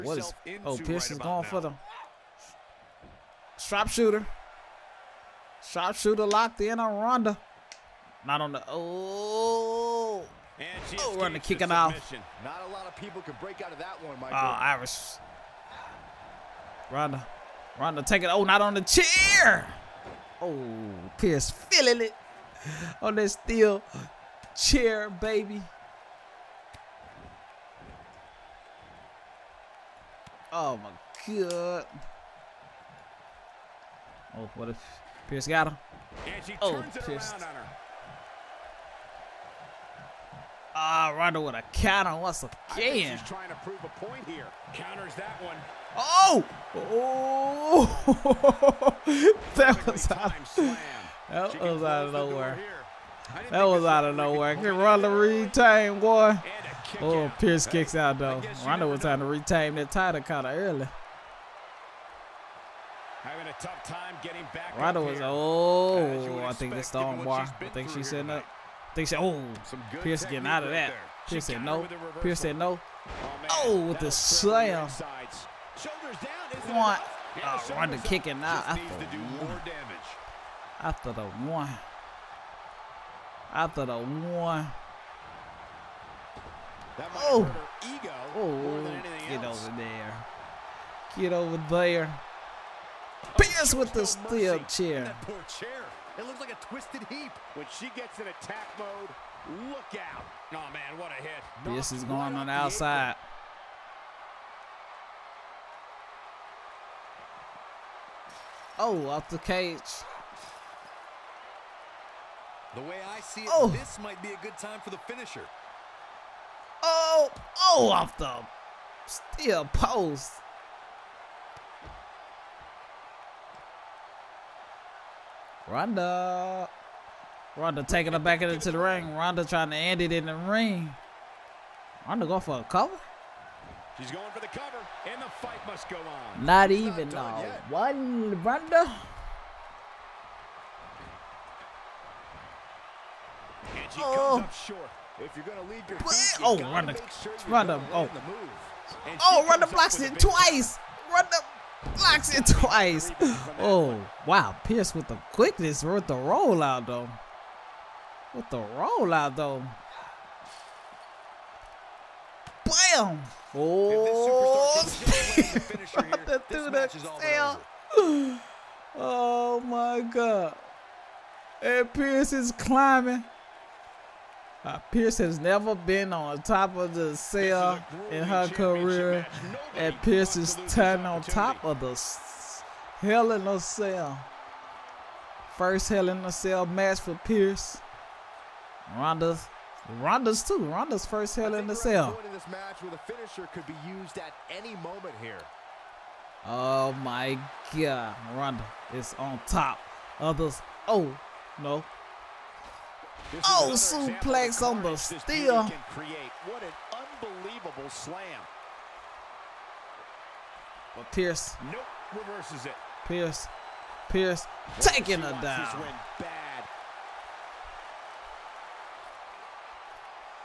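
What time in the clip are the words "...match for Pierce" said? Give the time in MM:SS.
03:06.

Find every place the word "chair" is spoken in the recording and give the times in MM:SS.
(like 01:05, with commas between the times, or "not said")
00:18, 00:24, 01:34.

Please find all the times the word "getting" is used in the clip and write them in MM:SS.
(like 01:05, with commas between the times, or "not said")
01:04, 01:10.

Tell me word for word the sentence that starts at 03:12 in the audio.
this match where the finisher could be used at any moment here.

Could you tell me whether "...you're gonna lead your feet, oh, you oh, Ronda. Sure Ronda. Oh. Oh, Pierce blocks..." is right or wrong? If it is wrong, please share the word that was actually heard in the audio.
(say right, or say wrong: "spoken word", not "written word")
wrong: "Ronda", not "Pierce".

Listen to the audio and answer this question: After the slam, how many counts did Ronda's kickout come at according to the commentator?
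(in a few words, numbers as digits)
1.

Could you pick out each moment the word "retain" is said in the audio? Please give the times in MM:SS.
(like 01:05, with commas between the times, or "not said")
00:55, 00:59.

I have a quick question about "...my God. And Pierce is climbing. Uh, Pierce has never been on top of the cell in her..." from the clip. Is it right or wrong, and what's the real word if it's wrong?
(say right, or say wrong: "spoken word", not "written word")
right.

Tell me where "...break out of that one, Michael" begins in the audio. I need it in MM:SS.
00:13.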